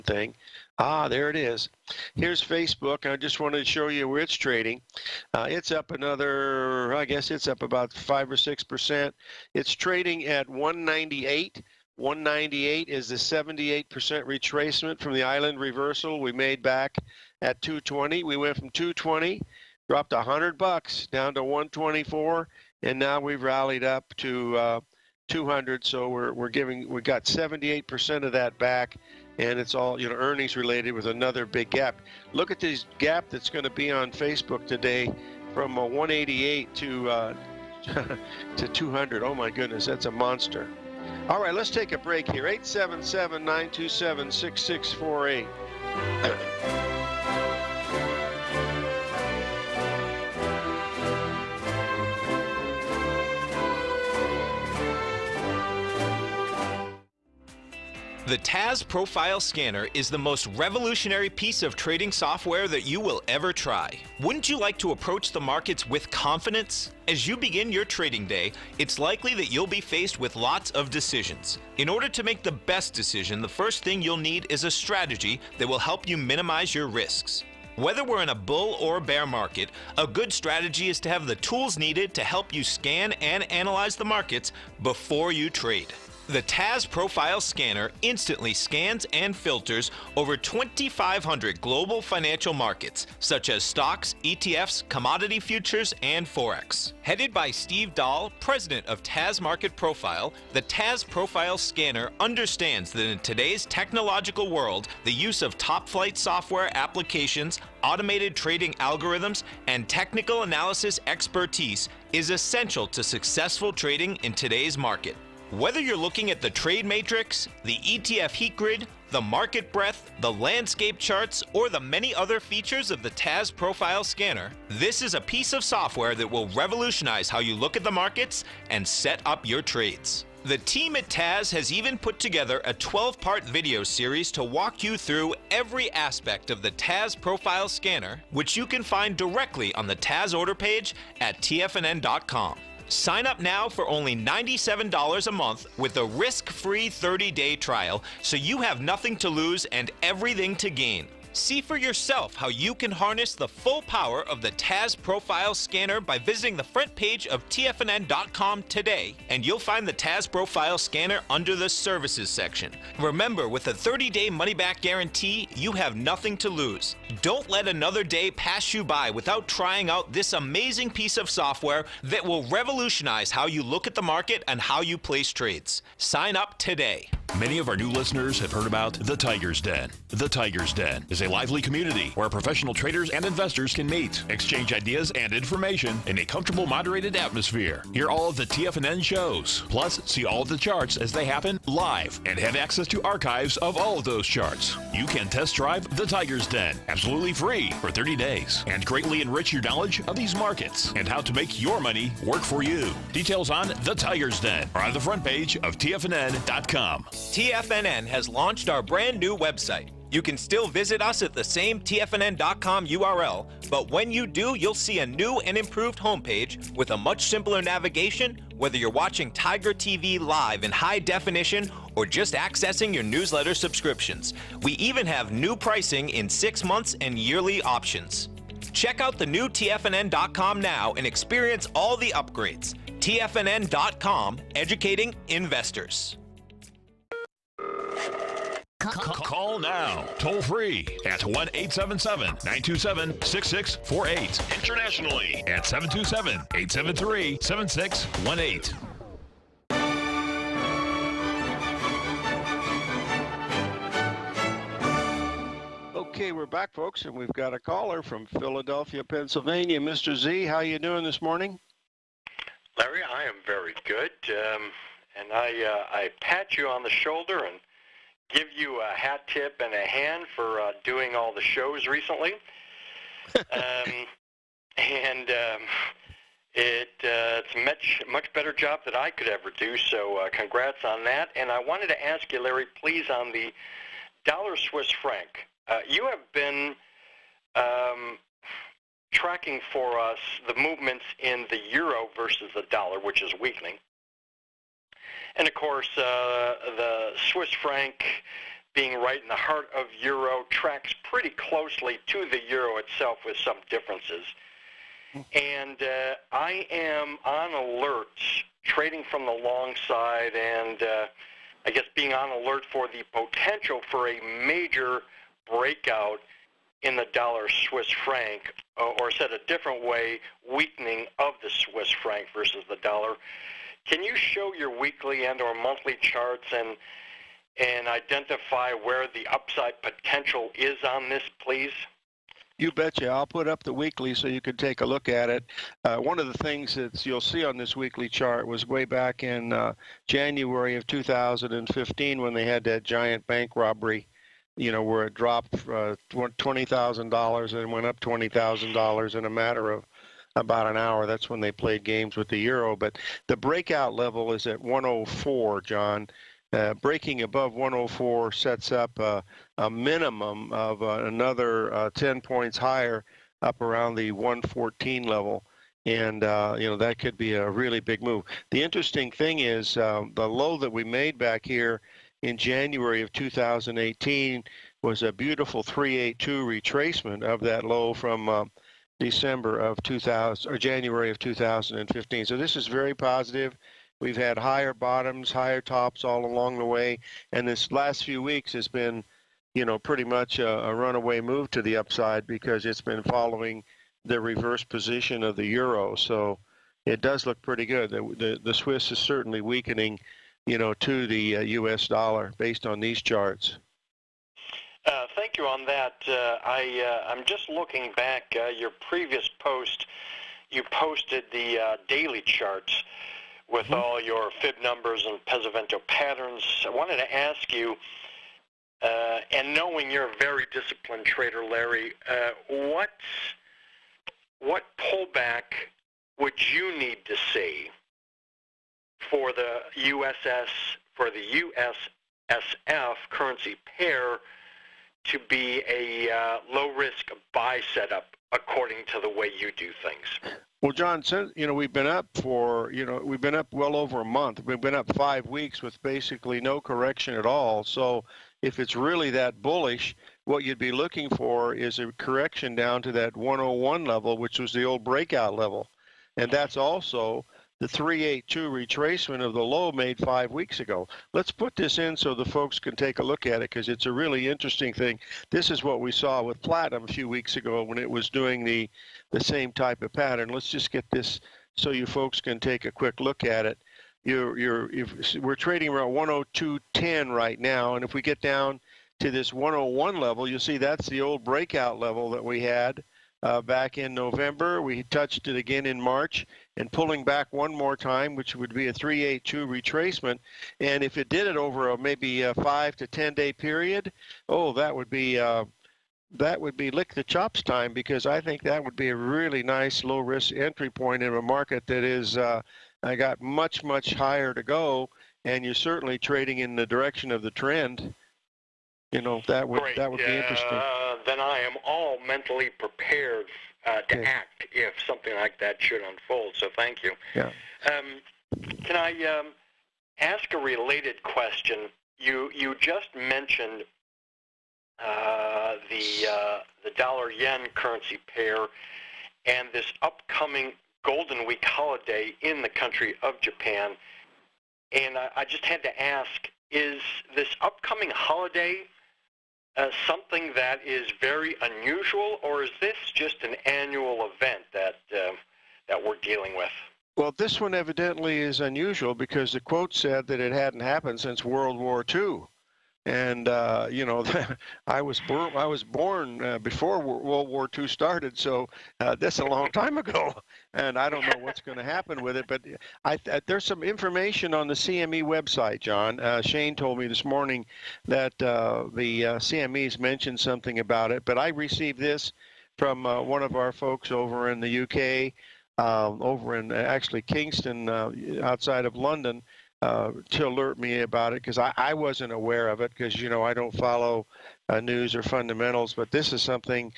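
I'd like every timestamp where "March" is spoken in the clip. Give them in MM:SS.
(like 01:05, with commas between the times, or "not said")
08:05.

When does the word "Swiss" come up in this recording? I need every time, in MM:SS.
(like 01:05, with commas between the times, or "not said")
04:44, 04:57, 05:17, 05:21, 06:38.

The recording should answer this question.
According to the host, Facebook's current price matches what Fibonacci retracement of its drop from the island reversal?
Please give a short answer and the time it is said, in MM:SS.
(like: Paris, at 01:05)
78%, at 00:13.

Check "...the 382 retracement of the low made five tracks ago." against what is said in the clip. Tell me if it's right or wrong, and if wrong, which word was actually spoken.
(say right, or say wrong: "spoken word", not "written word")
wrong: "weeks", not "tracks".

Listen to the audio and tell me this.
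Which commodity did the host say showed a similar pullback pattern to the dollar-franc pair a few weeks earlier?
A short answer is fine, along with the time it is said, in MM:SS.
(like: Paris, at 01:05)
Platinum, at 07:46.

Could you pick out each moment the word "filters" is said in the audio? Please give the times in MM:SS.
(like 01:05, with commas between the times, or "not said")
01:29.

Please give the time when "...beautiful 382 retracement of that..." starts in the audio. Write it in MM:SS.
06:15.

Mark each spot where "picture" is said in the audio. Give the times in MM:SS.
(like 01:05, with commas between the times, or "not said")
not said.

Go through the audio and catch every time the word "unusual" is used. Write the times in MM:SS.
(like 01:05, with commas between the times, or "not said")
09:01, 09:08.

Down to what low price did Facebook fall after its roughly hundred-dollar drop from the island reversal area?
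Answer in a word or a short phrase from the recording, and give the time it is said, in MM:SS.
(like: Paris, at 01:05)
124, at 00:21.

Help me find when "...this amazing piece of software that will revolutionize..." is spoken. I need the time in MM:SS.
02:50.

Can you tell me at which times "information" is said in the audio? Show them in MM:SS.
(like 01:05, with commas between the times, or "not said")
03:05, 09:23.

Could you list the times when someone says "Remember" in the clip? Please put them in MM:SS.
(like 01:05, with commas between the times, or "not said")
02:42.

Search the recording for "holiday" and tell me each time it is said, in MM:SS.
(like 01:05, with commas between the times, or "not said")
08:51, 08:57.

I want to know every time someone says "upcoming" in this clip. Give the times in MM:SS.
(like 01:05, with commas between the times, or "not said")
08:49, 08:57.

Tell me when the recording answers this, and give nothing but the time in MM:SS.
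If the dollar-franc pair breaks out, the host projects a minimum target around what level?
06:04.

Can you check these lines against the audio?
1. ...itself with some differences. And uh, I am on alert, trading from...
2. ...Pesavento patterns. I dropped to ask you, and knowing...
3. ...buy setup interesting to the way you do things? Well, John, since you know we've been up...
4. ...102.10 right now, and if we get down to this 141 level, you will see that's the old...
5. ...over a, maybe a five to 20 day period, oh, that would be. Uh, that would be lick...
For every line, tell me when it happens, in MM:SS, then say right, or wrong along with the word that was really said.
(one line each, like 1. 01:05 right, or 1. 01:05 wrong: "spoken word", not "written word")
1. 05:02 right
2. 06:55 wrong: "wanted", not "dropped"
3. 07:17 wrong: "according", not "interesting"
4. 07:55 wrong: "101", not "141"
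5. 08:11 wrong: "10", not "20".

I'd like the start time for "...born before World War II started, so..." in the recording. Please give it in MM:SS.
09:15.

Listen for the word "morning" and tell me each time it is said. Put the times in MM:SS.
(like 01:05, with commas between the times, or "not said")
04:21, 09:27.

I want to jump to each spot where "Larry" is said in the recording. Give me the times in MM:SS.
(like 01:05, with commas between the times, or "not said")
04:22, 04:42, 07:01.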